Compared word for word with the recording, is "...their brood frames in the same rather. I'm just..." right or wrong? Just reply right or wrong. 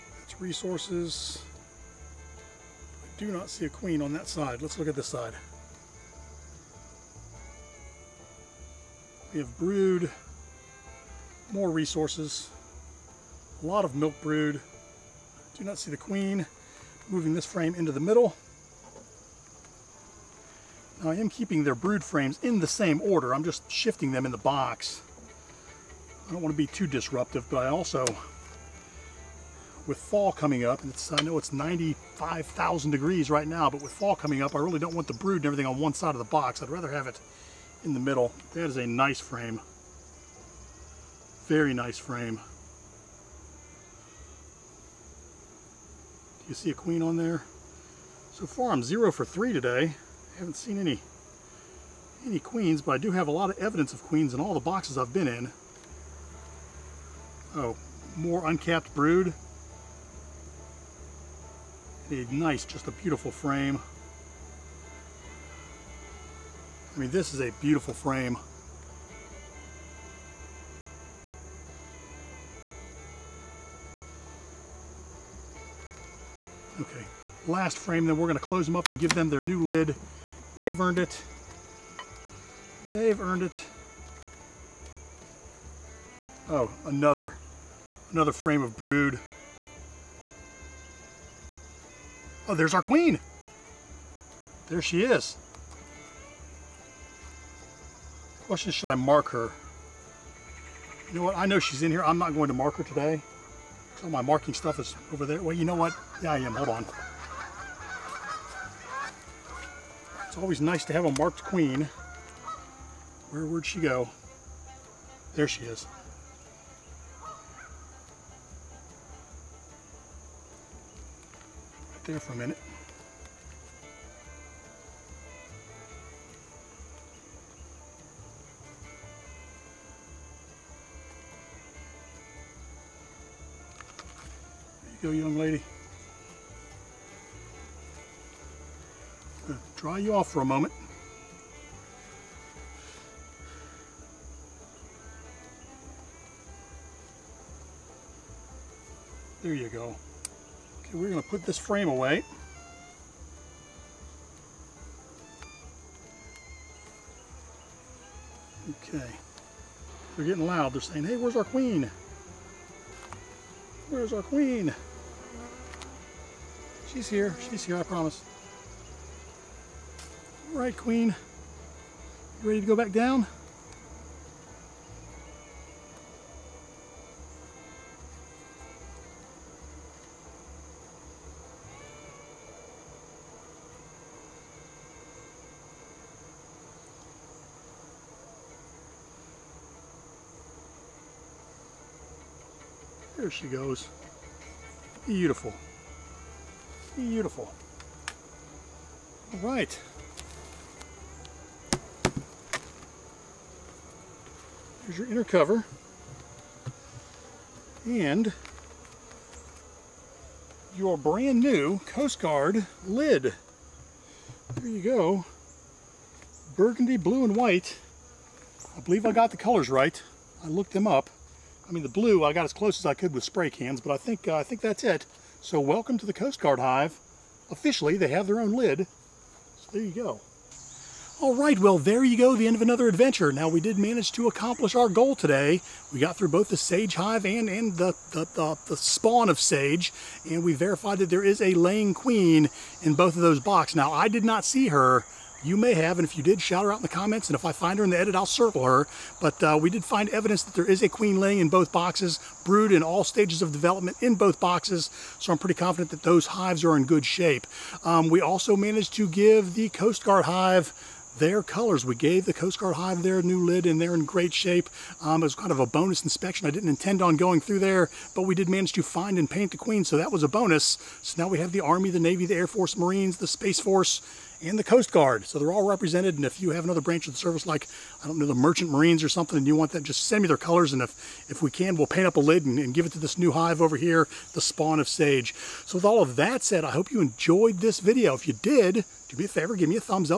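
wrong.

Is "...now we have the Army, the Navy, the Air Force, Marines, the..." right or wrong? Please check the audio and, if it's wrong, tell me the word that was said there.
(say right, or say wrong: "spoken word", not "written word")
right.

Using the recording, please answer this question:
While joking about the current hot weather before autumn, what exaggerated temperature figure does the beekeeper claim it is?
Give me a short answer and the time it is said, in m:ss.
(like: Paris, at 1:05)
95,000 degrees, at 0:31.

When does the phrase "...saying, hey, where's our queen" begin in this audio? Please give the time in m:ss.
2:40.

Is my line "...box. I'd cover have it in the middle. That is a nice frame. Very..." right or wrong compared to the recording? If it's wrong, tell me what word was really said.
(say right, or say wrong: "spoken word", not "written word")
wrong: "rather", not "cover".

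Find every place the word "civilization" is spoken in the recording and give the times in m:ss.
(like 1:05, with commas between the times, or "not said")
not said.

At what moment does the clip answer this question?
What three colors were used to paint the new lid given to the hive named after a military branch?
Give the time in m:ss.
3:36.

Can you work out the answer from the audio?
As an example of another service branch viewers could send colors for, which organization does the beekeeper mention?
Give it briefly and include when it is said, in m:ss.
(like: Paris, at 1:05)
Merchant Marines, at 4:38.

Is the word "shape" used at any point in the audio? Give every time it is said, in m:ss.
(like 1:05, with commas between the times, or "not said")
4:17, 4:24.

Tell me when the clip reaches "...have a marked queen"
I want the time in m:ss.
1:50.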